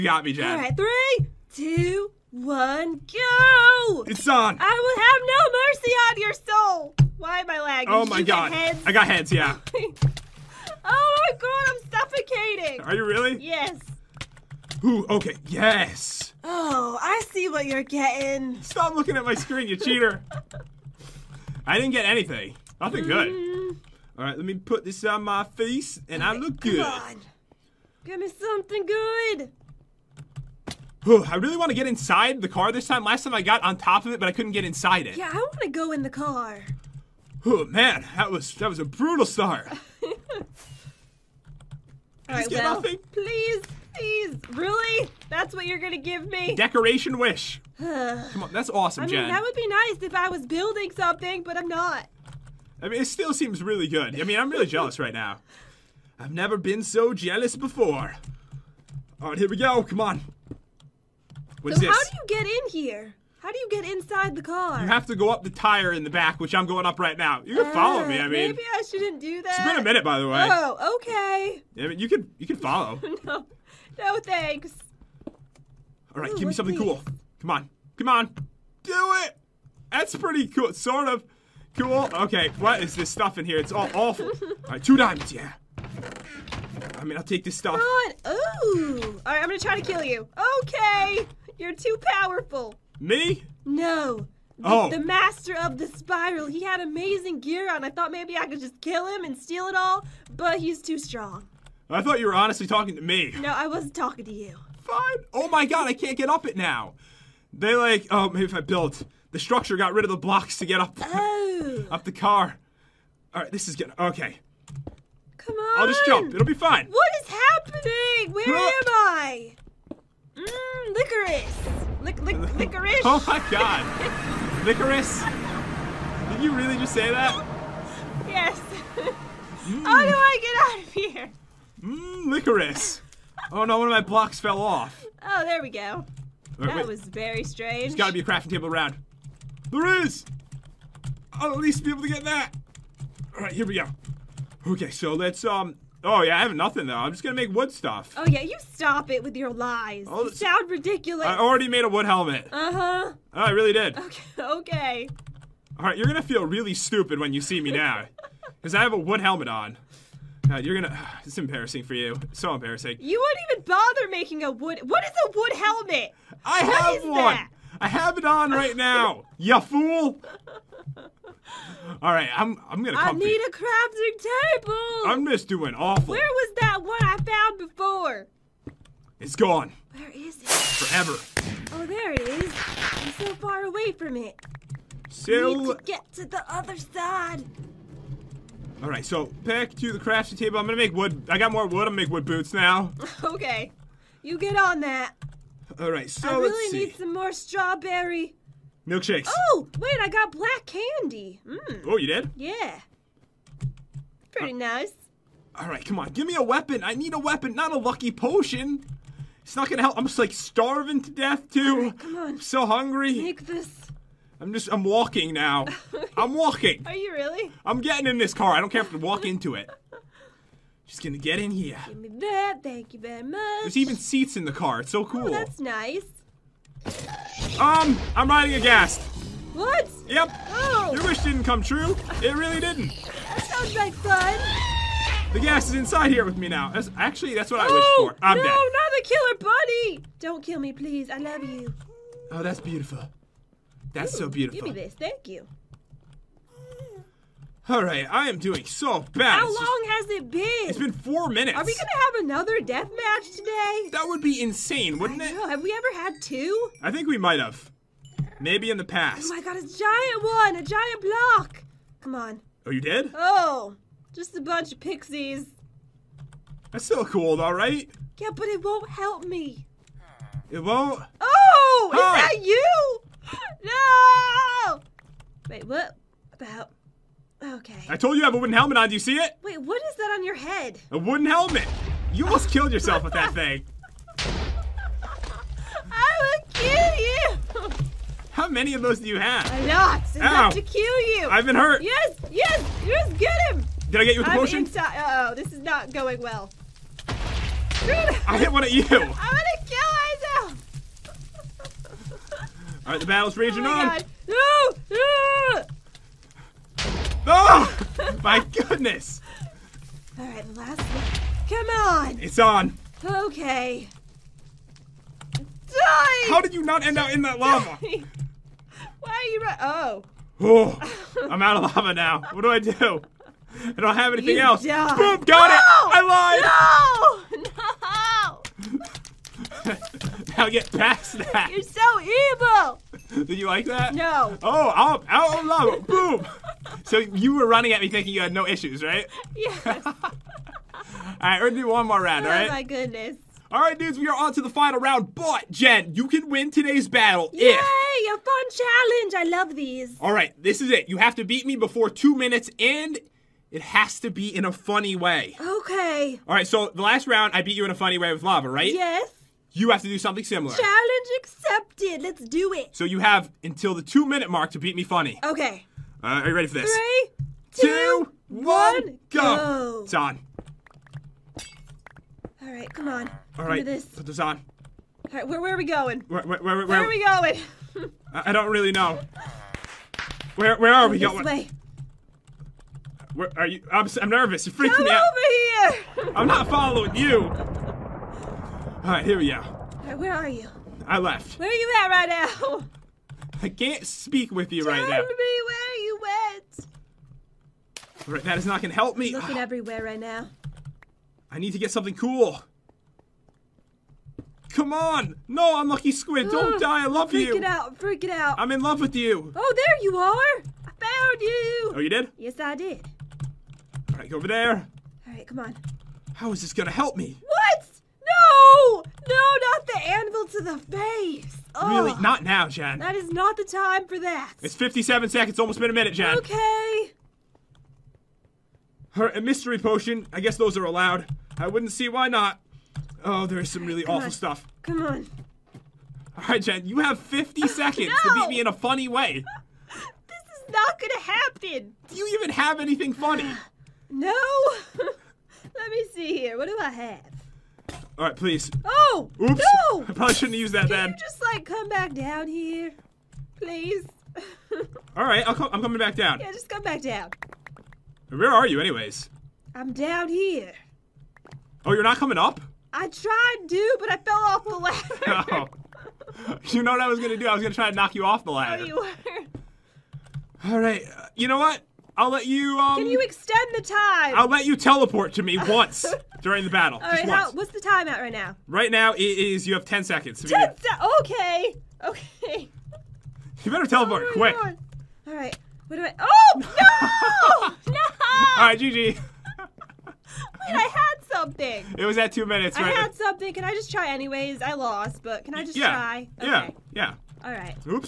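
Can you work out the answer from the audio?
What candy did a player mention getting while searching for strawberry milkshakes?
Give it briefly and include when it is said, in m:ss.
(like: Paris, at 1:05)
Black candy, at 3:20.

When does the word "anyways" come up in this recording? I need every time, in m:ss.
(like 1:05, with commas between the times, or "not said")
7:38, 8:13.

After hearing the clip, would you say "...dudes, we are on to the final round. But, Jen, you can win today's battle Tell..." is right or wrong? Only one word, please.
wrong.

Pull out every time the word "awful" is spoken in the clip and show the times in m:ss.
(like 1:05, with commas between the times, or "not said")
1:23, 2:55, 7:13.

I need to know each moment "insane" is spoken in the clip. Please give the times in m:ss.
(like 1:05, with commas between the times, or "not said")
4:14.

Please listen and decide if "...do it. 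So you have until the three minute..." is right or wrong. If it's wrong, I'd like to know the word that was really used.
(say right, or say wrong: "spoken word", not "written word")
wrong: "two", not "three".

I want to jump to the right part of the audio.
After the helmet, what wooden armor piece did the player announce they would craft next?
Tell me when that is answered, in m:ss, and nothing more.
3:12.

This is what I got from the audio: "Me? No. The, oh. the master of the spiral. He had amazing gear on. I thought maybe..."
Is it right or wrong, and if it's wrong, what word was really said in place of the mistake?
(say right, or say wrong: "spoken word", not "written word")
right.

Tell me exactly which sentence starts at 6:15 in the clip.
All right, where, where are we going?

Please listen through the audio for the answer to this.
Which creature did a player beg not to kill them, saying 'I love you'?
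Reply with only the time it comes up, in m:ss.
3:59.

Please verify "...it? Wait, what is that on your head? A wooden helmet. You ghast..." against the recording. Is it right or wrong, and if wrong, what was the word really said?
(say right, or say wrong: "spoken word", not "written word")
wrong: "almost", not "ghast".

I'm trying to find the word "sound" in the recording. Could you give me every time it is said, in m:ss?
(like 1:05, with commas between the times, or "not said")
2:30, 3:53.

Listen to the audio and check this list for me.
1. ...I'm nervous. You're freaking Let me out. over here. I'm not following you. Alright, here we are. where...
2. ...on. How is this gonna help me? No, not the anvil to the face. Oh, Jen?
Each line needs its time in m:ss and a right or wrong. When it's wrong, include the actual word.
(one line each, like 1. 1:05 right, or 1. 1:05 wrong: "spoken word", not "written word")
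1. 6:23 wrong: "Come", not "Let"
2. 6:55 wrong: "Really", not "Jen".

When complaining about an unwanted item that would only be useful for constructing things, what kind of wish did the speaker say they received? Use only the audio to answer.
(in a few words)
Decoration wish.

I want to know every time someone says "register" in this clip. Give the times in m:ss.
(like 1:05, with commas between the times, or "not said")
not said.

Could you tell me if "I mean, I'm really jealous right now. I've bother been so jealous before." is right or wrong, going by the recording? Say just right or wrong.
wrong.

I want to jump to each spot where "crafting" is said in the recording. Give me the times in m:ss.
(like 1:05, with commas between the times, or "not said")
2:18, 2:53, 3:09.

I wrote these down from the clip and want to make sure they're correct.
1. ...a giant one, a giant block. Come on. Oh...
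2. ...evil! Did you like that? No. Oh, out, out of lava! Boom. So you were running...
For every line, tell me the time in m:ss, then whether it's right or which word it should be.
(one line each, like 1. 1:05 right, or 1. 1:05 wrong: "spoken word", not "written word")
1. 4:19 right
2. 5:31 right.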